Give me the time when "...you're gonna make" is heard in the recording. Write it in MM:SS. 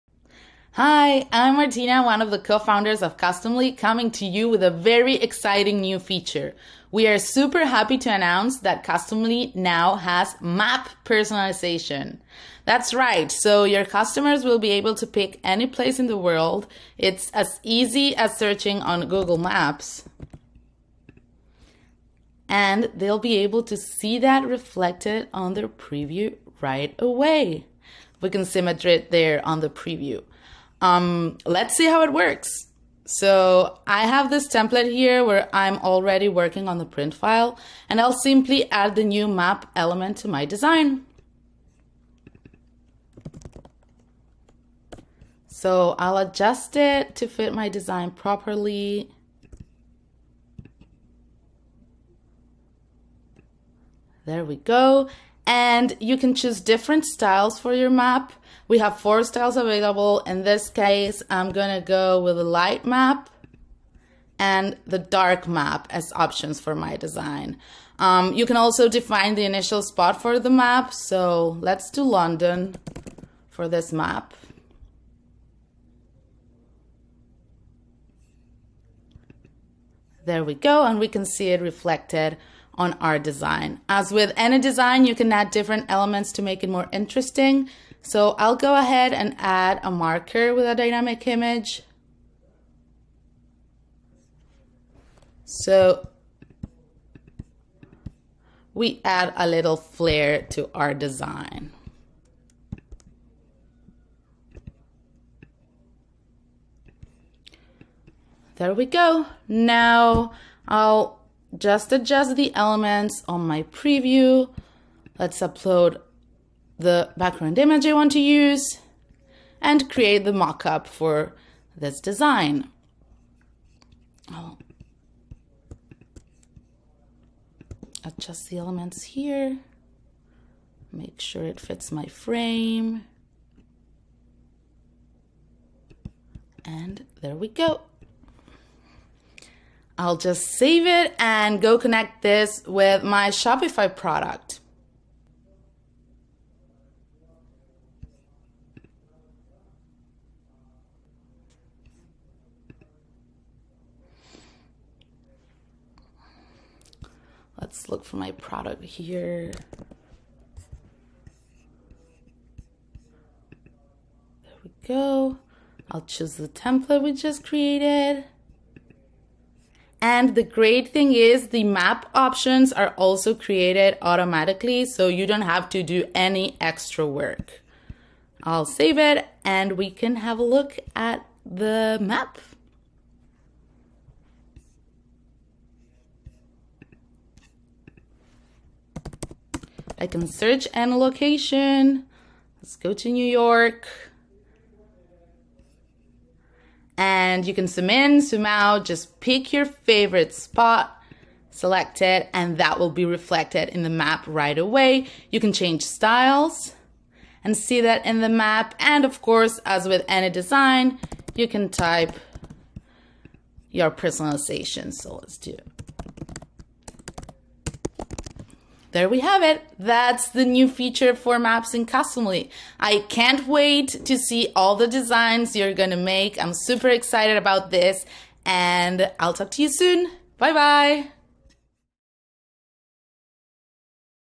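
03:45.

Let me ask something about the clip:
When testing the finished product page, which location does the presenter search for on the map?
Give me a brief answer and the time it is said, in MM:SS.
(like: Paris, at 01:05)
New York, at 03:13.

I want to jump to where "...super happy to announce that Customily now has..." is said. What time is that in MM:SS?
00:07.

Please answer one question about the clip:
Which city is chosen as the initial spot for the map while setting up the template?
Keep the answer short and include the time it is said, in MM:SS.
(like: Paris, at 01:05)
London, at 01:12.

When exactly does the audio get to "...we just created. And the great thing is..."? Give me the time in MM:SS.
02:47.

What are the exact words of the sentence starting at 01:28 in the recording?
So I'll go ahead and add a marker with a dynamic image.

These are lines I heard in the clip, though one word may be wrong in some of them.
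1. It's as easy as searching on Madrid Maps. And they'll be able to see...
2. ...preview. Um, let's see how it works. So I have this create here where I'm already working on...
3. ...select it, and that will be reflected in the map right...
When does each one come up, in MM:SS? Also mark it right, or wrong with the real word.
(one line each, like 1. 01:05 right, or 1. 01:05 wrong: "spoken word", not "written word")
1. 00:16 wrong: "Google", not "Madrid"
2. 00:29 wrong: "template", not "create"
3. 03:21 right.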